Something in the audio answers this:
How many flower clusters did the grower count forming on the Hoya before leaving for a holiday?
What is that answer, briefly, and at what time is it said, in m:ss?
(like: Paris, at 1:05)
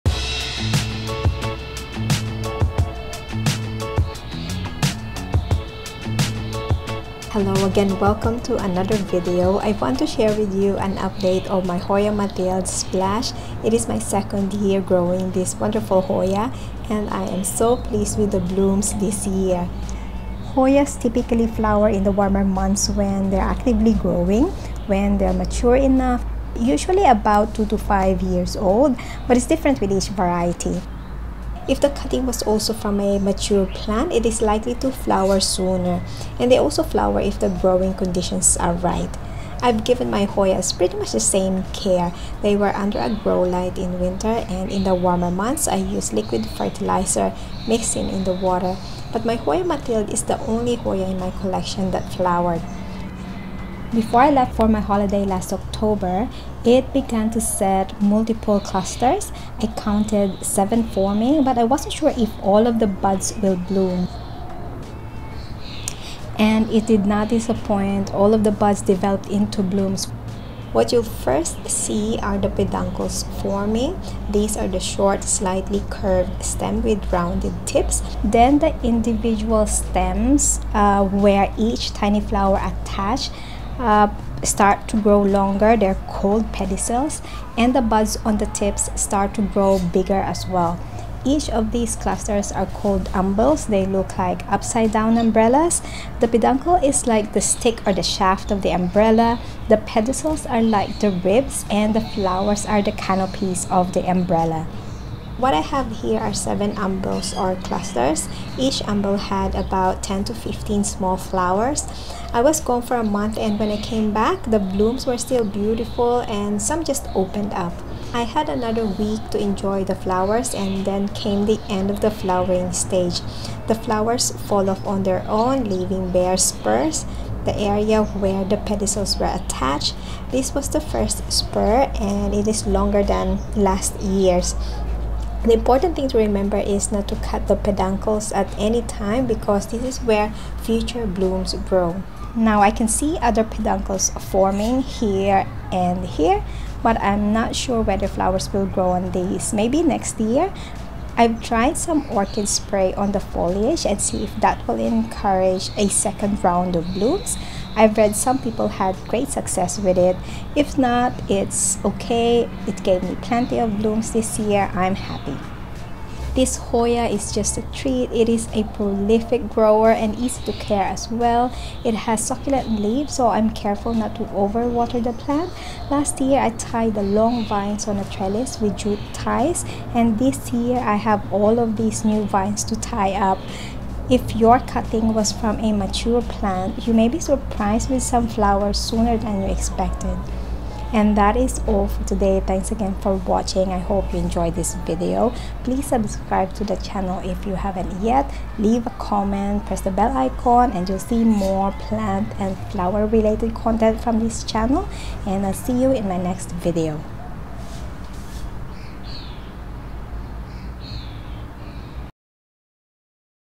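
7, at 1:00.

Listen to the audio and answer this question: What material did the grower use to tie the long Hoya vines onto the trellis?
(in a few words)
jute ties.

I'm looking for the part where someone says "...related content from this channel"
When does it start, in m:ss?
3:23.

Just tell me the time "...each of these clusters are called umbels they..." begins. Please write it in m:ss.
1:31.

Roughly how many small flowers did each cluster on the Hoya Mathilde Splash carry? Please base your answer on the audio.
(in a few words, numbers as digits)
10 to 15.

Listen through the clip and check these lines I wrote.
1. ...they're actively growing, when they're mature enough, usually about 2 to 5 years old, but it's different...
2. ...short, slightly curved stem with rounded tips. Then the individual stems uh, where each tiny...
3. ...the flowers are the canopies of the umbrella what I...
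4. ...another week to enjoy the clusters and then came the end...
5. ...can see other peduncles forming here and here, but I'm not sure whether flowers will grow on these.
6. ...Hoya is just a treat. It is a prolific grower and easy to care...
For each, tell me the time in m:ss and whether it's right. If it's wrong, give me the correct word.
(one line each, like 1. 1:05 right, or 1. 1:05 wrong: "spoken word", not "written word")
1. 0:23 right
2. 1:14 right
3. 1:41 right
4. 1:58 wrong: "flowers", not "clusters"
5. 2:22 right
6. 2:46 right.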